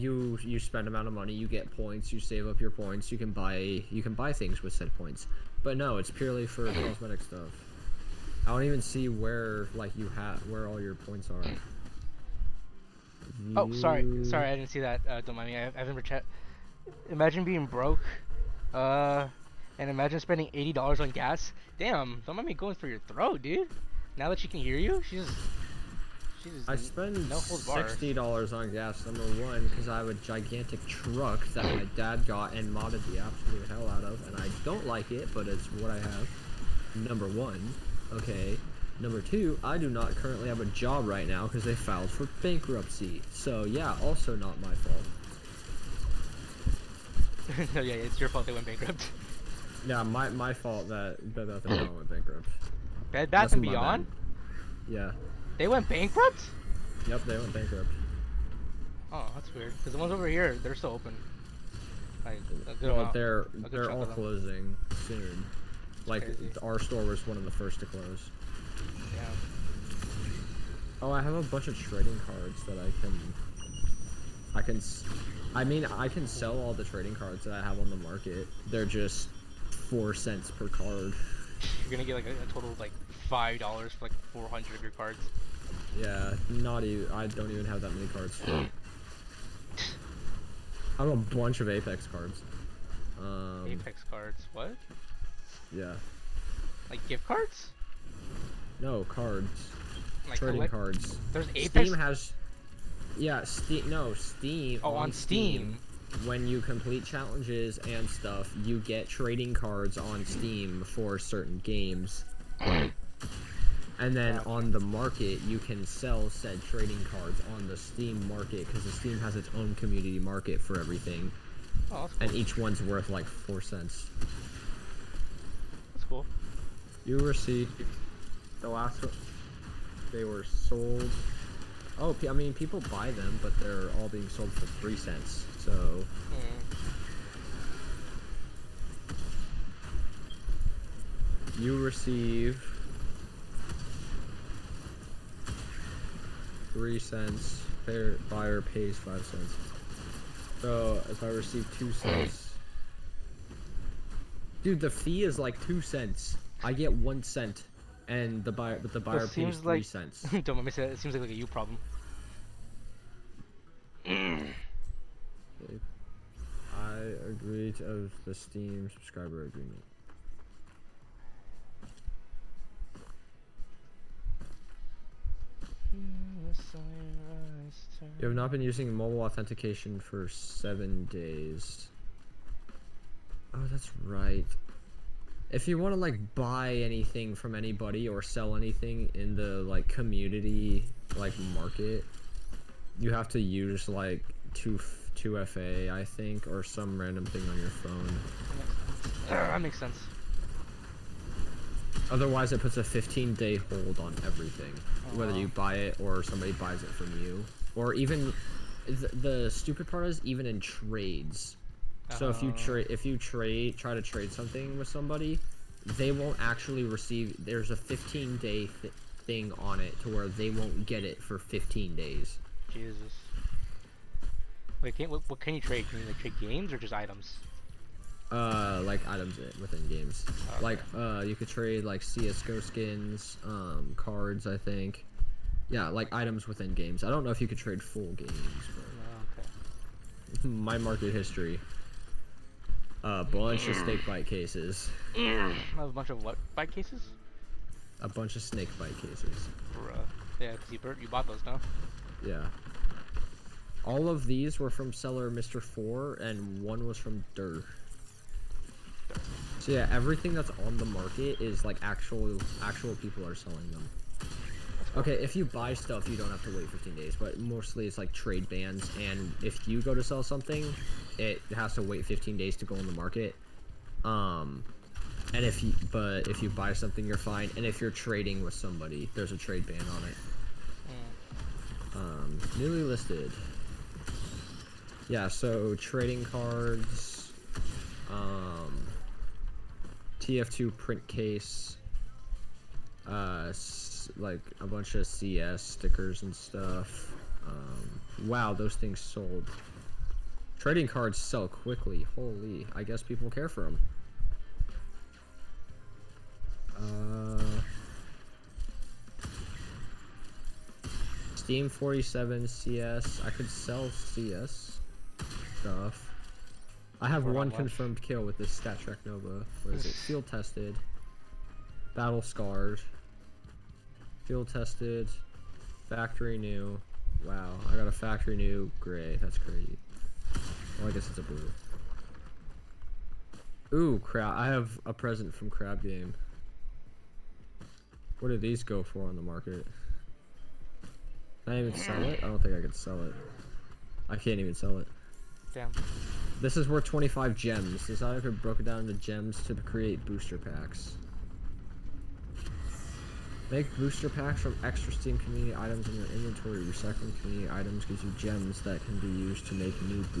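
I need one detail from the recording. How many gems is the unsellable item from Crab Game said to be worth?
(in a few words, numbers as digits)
25.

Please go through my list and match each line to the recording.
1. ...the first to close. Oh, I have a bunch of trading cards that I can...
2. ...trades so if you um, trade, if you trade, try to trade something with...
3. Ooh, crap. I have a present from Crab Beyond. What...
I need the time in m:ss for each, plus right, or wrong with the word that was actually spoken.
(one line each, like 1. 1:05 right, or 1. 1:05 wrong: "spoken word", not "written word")
1. 1:07 right
2. 3:30 right
3. 5:33 wrong: "Game", not "Beyond".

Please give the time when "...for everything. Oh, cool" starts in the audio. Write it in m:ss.
2:00.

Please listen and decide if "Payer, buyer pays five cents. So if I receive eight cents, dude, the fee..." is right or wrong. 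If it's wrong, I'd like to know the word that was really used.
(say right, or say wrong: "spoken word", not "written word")
wrong: "two", not "eight".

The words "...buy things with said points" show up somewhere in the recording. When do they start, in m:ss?
0:04.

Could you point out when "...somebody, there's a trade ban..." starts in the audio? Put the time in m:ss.
4:38.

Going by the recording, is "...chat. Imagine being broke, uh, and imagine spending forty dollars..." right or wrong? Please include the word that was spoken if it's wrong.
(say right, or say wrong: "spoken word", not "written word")
wrong: "eighty", not "forty".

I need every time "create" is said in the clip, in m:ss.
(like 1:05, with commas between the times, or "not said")
5:49.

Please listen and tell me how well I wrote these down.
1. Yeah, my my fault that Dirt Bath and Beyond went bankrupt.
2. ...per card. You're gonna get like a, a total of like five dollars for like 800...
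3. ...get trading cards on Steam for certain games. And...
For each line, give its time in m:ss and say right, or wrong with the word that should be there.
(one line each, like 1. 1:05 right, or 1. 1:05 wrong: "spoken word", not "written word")
1. 0:49 wrong: "Bed", not "Dirt"
2. 1:20 wrong: "400", not "800"
3. 1:48 right.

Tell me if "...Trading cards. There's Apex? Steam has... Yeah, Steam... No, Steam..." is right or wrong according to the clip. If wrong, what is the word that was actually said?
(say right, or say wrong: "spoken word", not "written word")
right.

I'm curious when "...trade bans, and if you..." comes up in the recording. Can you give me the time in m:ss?
4:28.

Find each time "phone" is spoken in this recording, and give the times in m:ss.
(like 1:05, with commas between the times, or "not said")
3:17.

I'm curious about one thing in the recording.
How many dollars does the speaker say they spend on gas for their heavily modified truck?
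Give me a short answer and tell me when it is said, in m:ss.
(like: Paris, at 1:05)
60, at 0:27.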